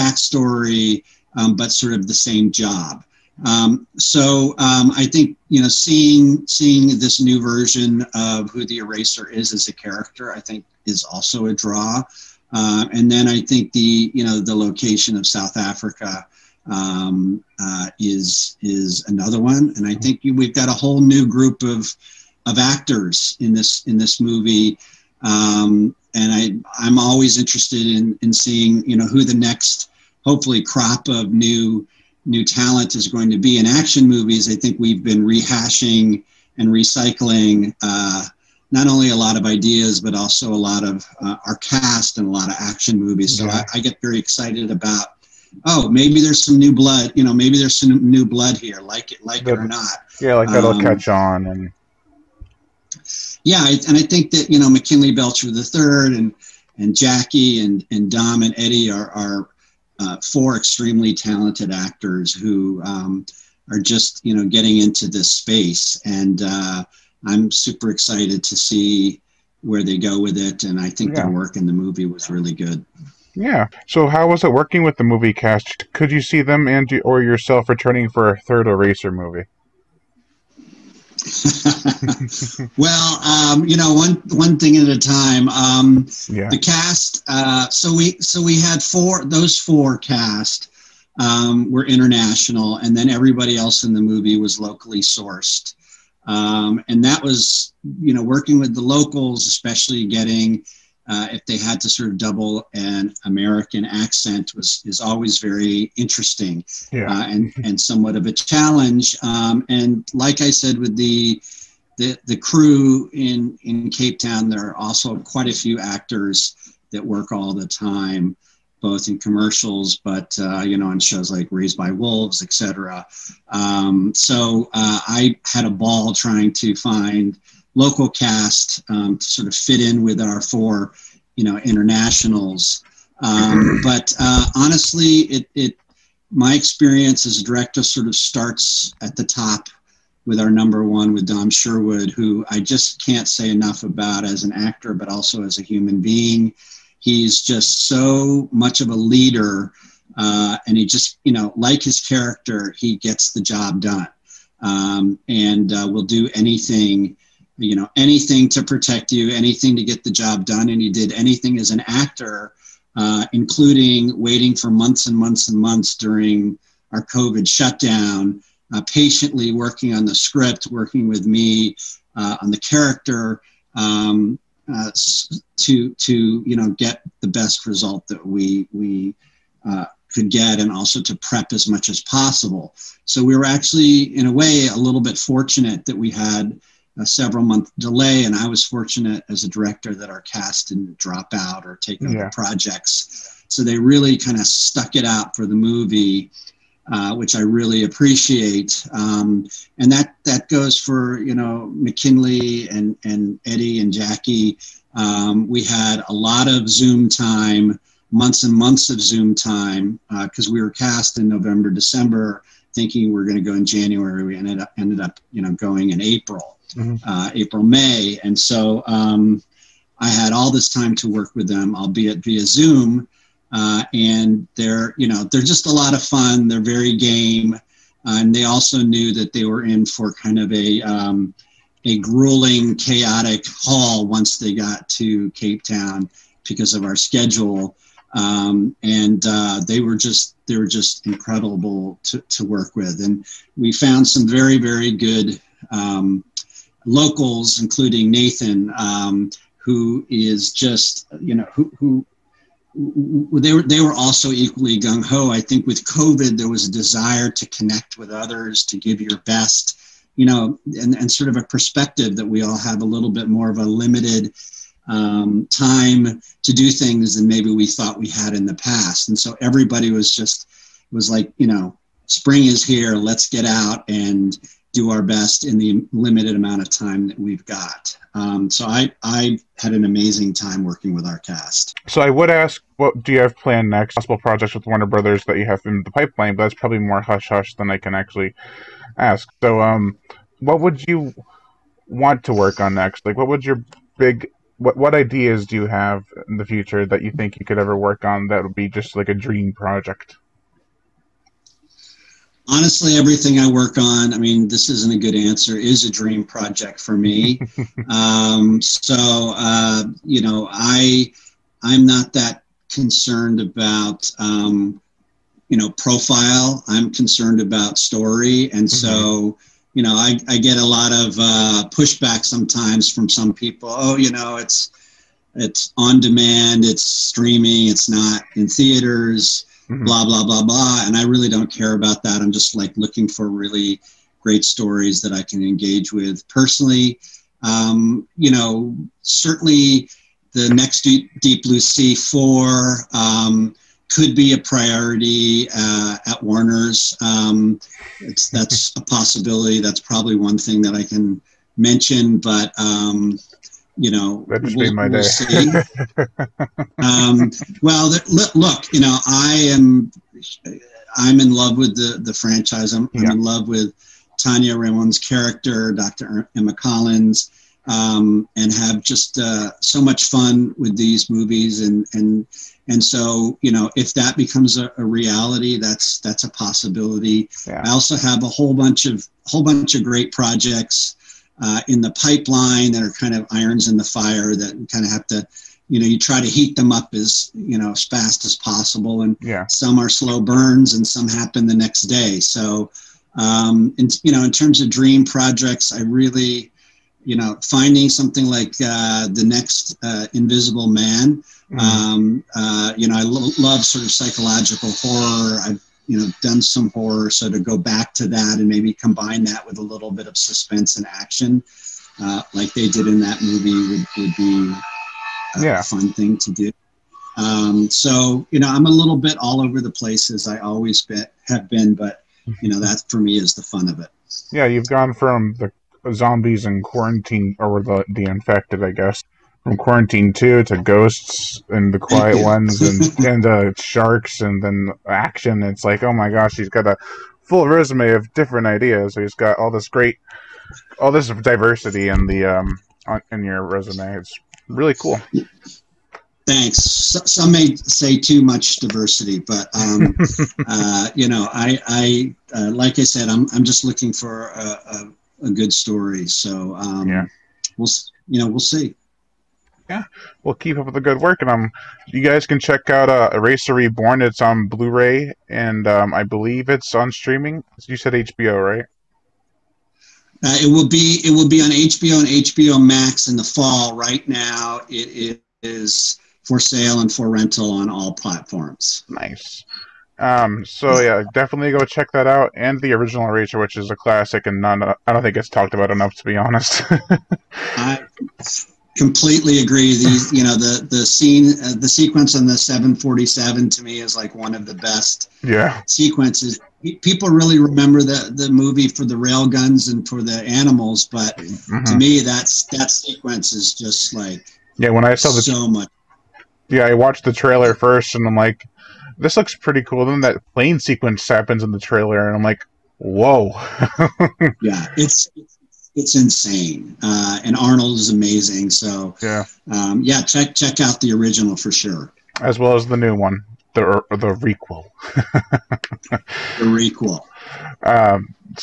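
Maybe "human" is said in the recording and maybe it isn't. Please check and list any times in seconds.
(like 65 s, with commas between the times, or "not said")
145 s.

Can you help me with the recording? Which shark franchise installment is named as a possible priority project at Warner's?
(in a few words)
Deep Blue Sea 4.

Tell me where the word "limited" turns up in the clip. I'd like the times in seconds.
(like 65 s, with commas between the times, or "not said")
263 s, 275 s.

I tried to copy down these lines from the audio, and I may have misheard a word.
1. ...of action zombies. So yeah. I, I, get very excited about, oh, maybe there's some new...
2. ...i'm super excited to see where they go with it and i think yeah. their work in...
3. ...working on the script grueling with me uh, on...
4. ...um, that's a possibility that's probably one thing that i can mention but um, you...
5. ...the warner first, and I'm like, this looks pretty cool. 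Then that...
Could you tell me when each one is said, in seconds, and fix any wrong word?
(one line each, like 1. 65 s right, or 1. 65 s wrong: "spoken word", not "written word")
1. 42 s wrong: "movies", not "zombies"
2. 67 s right
3. 169 s wrong: "working", not "grueling"
4. 347 s right
5. 507 s wrong: "trailer", not "warner".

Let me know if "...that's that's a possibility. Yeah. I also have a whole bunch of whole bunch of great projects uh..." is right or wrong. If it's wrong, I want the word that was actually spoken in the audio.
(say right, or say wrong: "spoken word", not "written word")
right.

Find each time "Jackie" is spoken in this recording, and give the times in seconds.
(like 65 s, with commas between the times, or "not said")
56 s, 203 s.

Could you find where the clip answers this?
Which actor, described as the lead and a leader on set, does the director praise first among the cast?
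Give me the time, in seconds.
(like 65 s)
141 s.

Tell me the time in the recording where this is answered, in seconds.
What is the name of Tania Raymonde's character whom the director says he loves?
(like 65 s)
366 s.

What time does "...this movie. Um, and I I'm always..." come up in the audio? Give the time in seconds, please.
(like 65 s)
23 s.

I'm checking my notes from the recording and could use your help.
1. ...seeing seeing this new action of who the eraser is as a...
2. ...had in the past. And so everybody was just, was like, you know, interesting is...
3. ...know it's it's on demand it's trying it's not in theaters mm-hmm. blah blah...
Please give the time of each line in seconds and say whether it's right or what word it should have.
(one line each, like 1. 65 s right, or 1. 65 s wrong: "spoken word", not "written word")
1. 5 s wrong: "version", not "action"
2. 268 s wrong: "spring", not "interesting"
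3. 324 s wrong: "streaming", not "trying".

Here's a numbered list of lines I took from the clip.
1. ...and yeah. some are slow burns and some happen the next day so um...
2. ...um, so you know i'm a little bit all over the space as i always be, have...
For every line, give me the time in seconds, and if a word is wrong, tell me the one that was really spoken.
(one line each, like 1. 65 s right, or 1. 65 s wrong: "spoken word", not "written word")
1. 389 s right
2. 417 s wrong: "place", not "space".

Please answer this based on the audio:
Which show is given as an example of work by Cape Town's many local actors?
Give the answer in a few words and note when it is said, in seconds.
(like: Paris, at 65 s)
Raised by Wolves, at 121 s.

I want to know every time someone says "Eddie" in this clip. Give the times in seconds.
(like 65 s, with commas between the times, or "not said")
58 s, 203 s.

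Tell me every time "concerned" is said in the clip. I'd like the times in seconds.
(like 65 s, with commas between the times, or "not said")
312 s, 316 s.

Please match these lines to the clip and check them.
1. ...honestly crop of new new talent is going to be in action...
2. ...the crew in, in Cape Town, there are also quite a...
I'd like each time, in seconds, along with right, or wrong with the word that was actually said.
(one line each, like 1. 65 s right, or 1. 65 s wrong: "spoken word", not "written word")
1. 30 s wrong: "hopefully", not "honestly"
2. 112 s right.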